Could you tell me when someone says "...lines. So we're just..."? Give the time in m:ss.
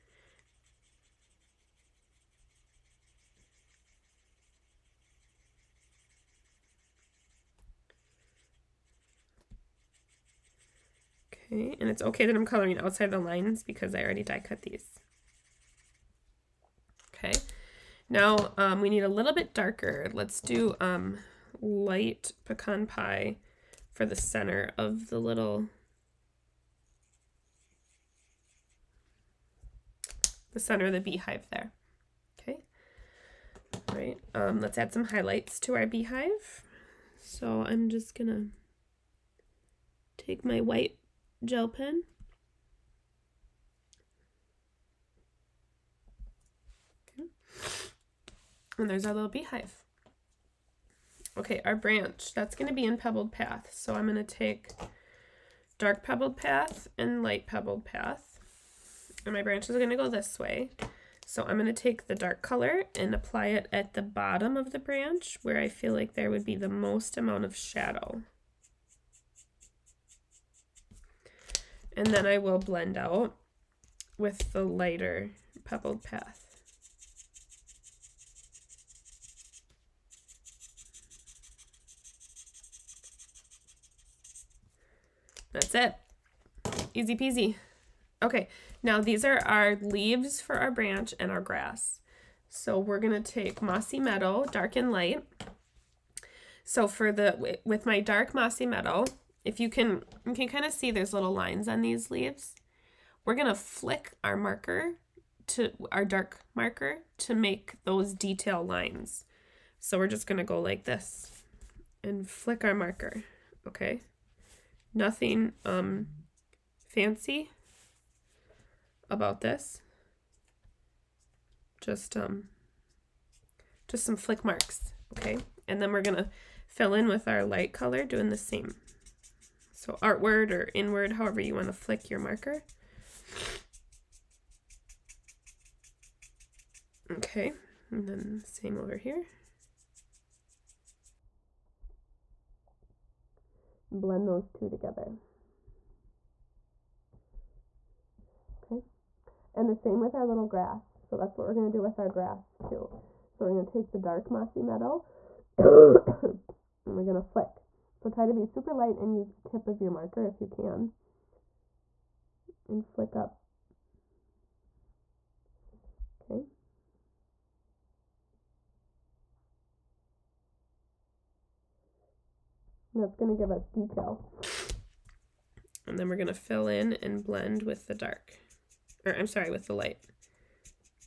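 1:48.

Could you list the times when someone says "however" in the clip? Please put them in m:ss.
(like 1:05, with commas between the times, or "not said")
2:11.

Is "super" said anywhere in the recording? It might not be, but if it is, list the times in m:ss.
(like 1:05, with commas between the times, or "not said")
2:38.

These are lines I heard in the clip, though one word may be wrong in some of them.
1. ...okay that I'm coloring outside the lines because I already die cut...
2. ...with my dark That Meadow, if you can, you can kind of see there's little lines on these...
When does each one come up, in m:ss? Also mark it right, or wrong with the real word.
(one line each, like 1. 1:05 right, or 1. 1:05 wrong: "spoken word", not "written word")
1. 0:12 right
2. 1:37 wrong: "Mossy", not "That".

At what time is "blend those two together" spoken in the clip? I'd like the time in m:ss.
2:24.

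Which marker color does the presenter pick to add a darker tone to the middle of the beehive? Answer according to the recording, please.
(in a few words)
Light Pecan Pie.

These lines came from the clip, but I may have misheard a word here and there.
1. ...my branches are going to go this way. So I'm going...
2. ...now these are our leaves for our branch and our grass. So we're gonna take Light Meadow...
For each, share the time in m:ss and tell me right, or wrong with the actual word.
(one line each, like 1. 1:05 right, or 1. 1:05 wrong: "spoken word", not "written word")
1. 0:59 right
2. 1:28 wrong: "Mossy", not "Light".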